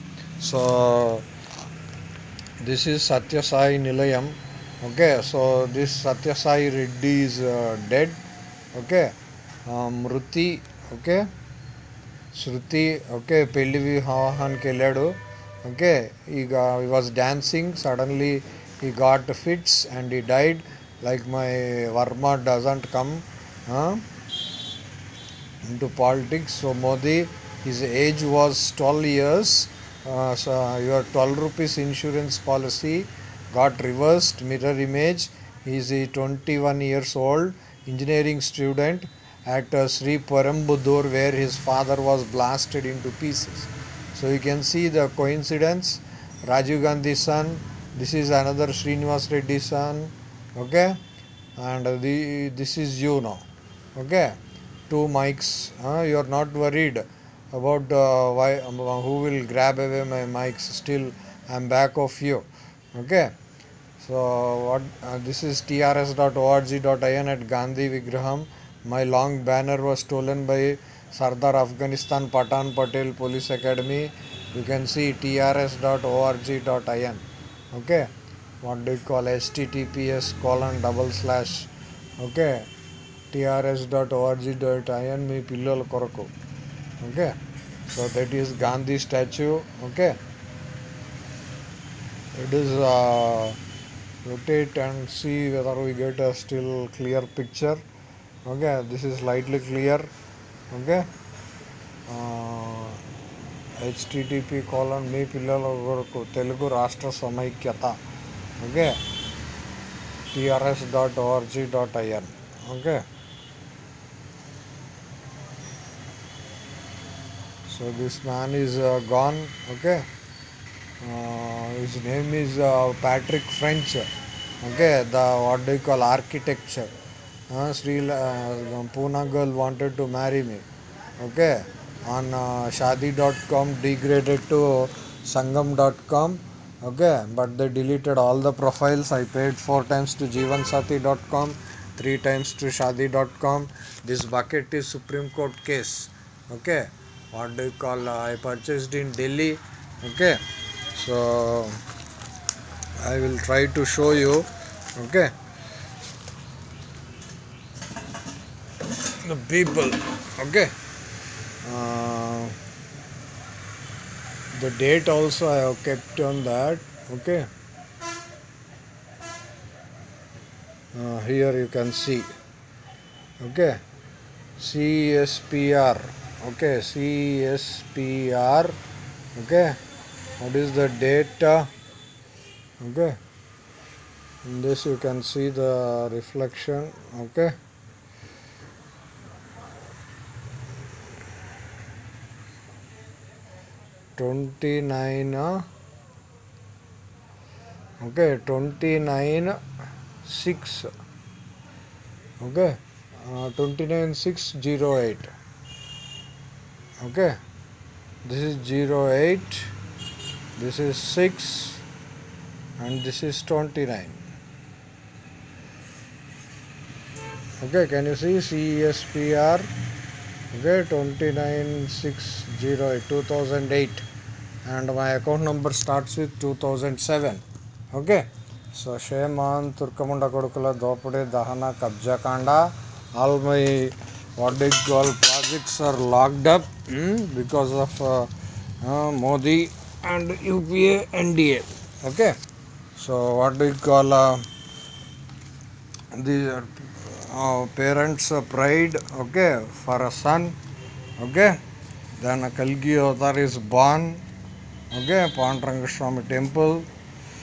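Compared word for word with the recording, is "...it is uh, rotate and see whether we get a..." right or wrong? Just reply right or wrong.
right.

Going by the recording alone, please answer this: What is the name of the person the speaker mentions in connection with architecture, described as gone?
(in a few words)
Patrick French.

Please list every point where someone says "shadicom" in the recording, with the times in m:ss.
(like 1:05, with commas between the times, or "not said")
2:12, 2:22.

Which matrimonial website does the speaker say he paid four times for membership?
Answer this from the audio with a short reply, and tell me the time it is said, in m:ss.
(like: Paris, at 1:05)
jeevansati.com, at 2:20.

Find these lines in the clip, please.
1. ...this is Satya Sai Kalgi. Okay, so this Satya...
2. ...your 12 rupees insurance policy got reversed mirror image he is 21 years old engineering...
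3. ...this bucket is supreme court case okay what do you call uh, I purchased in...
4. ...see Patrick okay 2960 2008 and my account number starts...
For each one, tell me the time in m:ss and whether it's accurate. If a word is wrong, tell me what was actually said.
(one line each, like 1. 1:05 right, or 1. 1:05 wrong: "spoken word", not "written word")
1. 0:02 wrong: "Nilayam", not "Kalgi"
2. 0:30 right
3. 2:24 right
4. 3:38 wrong: "CESPR", not "Patrick".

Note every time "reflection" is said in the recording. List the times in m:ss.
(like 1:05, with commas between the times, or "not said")
3:06.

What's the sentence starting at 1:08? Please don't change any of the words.
My long banner was stolen by Sardar Afghanistan Patan Patel Police Academy.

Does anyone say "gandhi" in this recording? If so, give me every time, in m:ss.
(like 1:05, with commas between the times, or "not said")
0:46, 1:07, 1:28.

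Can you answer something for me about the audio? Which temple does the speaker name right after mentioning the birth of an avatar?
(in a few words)
Pandrangaswamy temple.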